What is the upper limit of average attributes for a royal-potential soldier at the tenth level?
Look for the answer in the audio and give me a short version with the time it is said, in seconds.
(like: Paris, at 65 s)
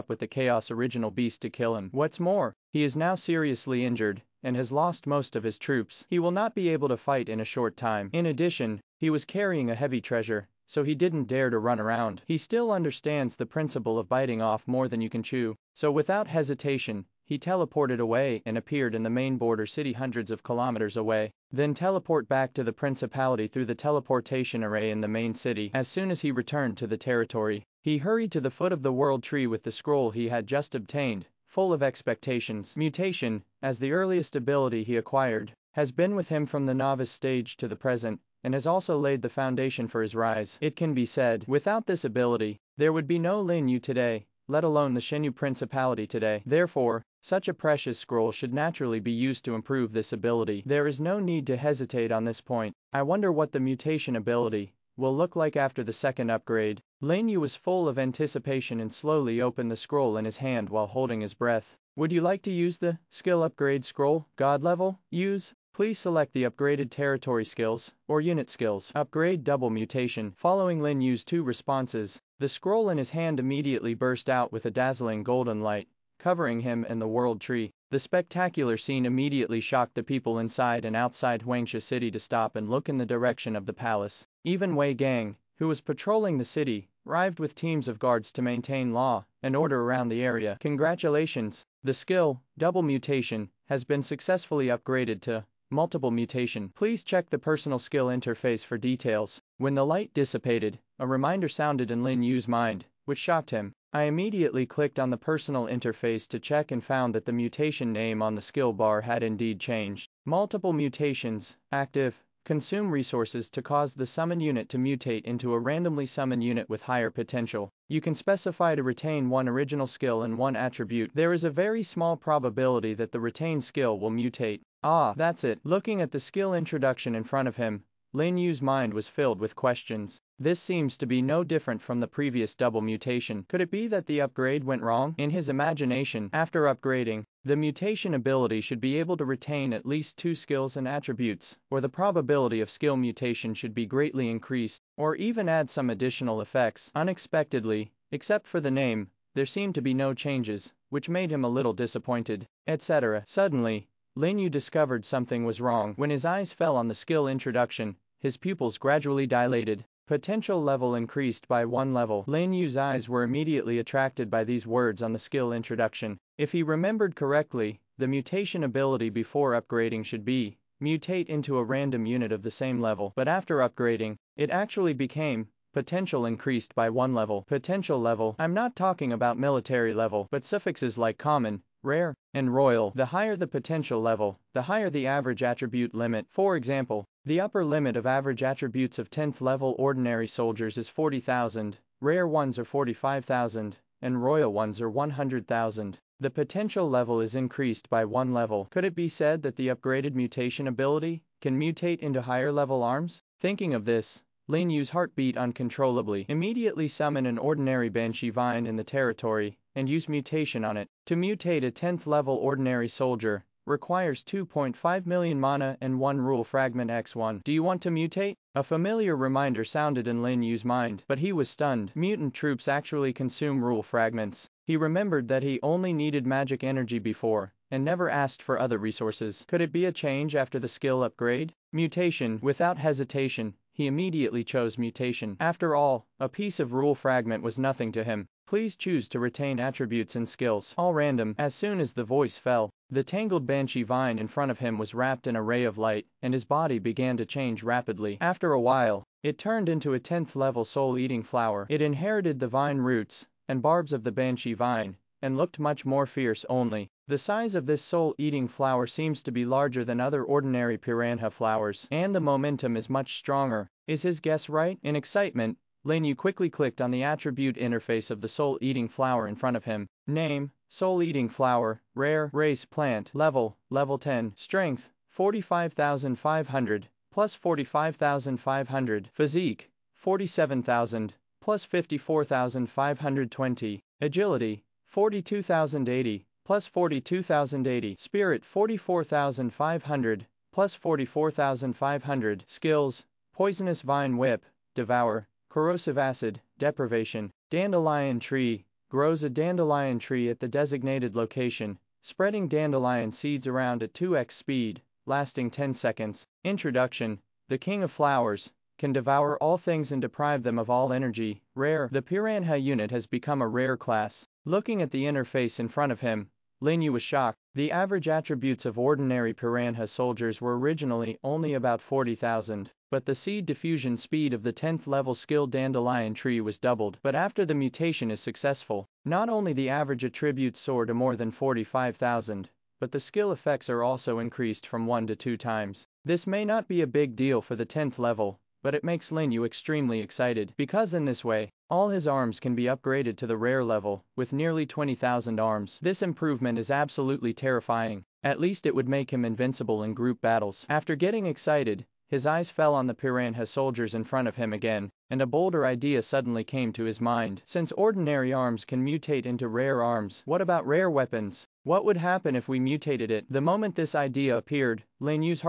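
100,000, at 194 s.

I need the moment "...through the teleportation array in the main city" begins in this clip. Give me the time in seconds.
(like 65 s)
23 s.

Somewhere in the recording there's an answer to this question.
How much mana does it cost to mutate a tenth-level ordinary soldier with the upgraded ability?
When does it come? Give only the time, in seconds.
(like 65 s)
214 s.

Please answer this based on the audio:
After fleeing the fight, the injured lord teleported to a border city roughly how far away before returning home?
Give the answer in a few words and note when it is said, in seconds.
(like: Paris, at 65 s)
hundreds of kilometers, at 19 s.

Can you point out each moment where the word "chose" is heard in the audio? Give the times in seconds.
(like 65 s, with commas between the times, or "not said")
234 s.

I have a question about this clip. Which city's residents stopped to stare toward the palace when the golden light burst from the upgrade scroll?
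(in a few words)
Huangsha City.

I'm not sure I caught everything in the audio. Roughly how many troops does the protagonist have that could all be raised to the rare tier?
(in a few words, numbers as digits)
nearly 20,000.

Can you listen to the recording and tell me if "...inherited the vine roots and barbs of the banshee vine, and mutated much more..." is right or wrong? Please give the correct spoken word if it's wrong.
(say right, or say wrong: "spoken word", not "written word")
wrong: "looked", not "mutated".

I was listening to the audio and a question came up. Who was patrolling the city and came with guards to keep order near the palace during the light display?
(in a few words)
Wei Gang.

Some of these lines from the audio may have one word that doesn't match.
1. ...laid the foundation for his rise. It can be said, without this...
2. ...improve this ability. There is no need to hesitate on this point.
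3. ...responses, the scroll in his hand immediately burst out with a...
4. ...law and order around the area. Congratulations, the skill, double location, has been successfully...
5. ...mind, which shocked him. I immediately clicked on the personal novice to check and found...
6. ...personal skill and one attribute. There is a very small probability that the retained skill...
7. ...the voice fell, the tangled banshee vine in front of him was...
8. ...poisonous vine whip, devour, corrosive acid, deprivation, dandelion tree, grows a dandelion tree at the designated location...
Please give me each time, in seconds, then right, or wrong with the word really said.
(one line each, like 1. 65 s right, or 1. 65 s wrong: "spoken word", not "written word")
1. 38 s right
2. 49 s right
3. 71 s right
4. 88 s wrong: "mutation", not "location"
5. 102 s wrong: "interface", not "novice"
6. 119 s wrong: "original", not "personal"
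7. 241 s right
8. 293 s right.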